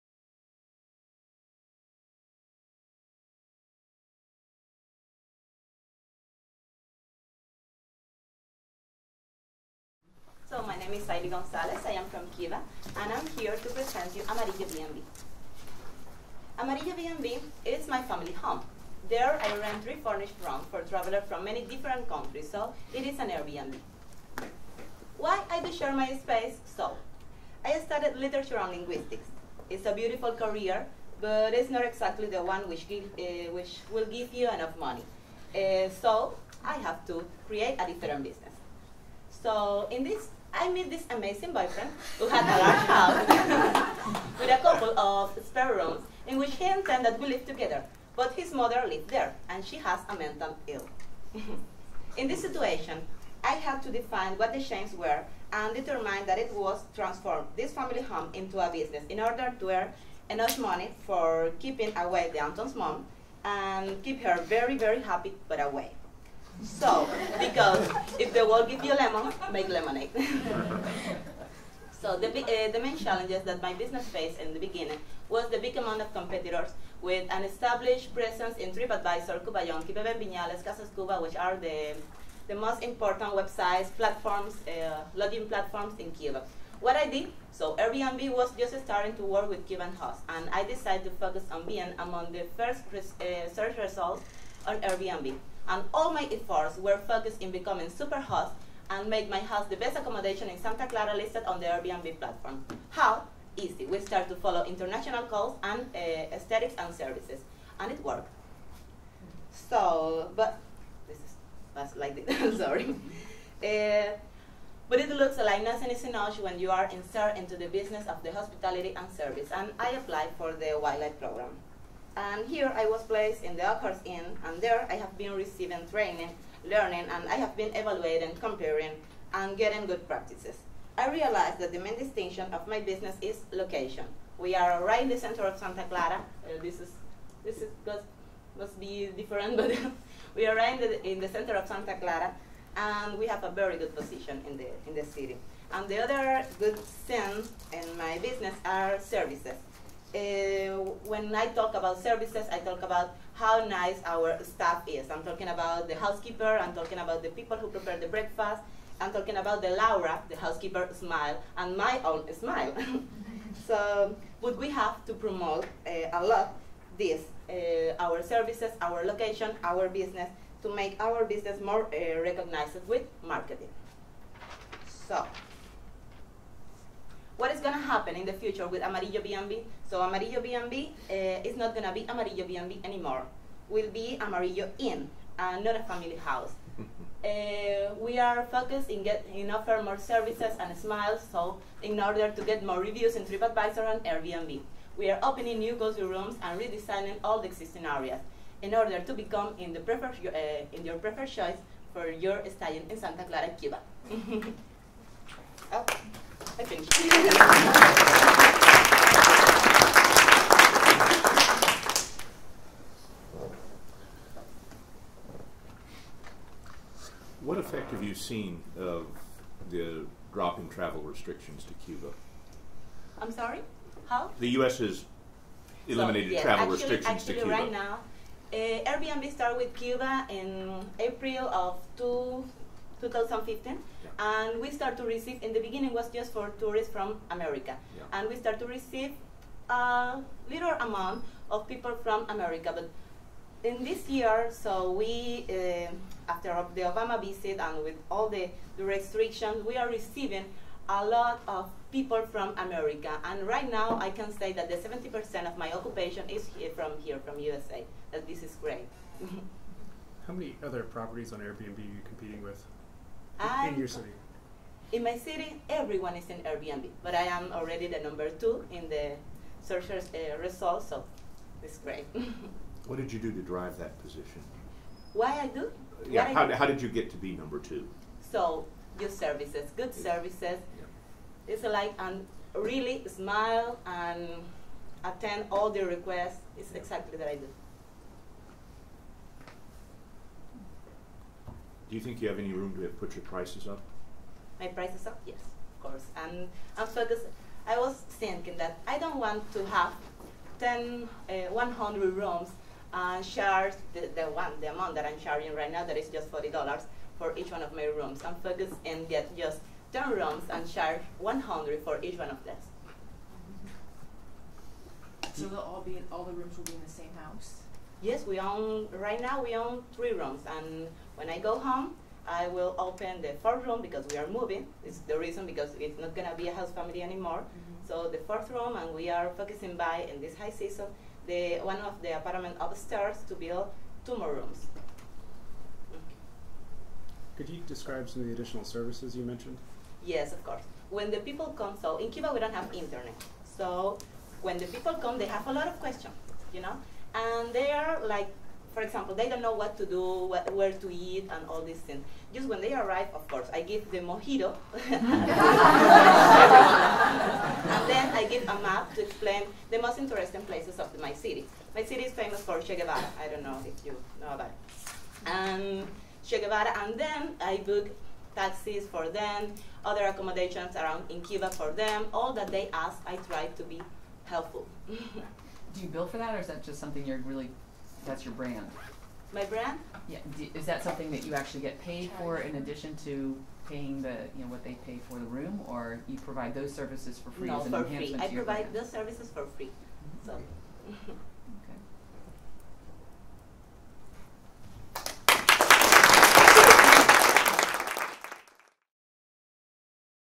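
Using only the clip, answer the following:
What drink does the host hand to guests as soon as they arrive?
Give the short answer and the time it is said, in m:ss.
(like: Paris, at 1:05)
mojito, at 5:54.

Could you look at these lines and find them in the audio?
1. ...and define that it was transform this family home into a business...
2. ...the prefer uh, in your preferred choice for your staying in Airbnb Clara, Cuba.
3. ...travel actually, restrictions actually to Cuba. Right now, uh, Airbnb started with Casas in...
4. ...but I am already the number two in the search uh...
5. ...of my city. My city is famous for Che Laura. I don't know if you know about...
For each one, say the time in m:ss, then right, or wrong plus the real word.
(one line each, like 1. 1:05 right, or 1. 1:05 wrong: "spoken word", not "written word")
1. 0:55 wrong: "determine", not "define"
2. 3:19 wrong: "Santa", not "Airbnb"
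3. 3:46 wrong: "Cuba", not "Casas"
4. 4:27 right
5. 6:00 wrong: "Guevara", not "Laura".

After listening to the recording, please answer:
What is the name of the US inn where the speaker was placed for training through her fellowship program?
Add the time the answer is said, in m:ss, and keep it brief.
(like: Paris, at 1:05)
Oakhurst Inn, at 2:03.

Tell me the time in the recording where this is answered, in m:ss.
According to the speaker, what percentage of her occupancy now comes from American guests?
4:14.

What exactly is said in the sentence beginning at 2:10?
I realized that the main distinction of my business is location.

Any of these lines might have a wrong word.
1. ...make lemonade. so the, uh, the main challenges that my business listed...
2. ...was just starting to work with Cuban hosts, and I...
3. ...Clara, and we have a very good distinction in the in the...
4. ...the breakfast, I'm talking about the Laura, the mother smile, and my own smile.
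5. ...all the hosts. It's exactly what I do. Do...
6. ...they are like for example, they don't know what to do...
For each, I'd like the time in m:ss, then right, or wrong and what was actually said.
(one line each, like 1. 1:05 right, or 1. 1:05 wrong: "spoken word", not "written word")
1. 1:09 wrong: "faced", not "listed"
2. 1:28 right
3. 2:21 wrong: "position", not "distinction"
4. 2:37 wrong: "housekeeper", not "mother"
5. 4:45 wrong: "requests", not "hosts"
6. 5:47 right.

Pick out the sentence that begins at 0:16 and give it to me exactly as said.
Amarillo B&B is my family home.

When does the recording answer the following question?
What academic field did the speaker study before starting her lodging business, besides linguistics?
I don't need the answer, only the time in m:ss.
0:28.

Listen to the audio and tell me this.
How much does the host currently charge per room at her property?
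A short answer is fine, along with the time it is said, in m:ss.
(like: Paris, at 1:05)
$40, at 5:06.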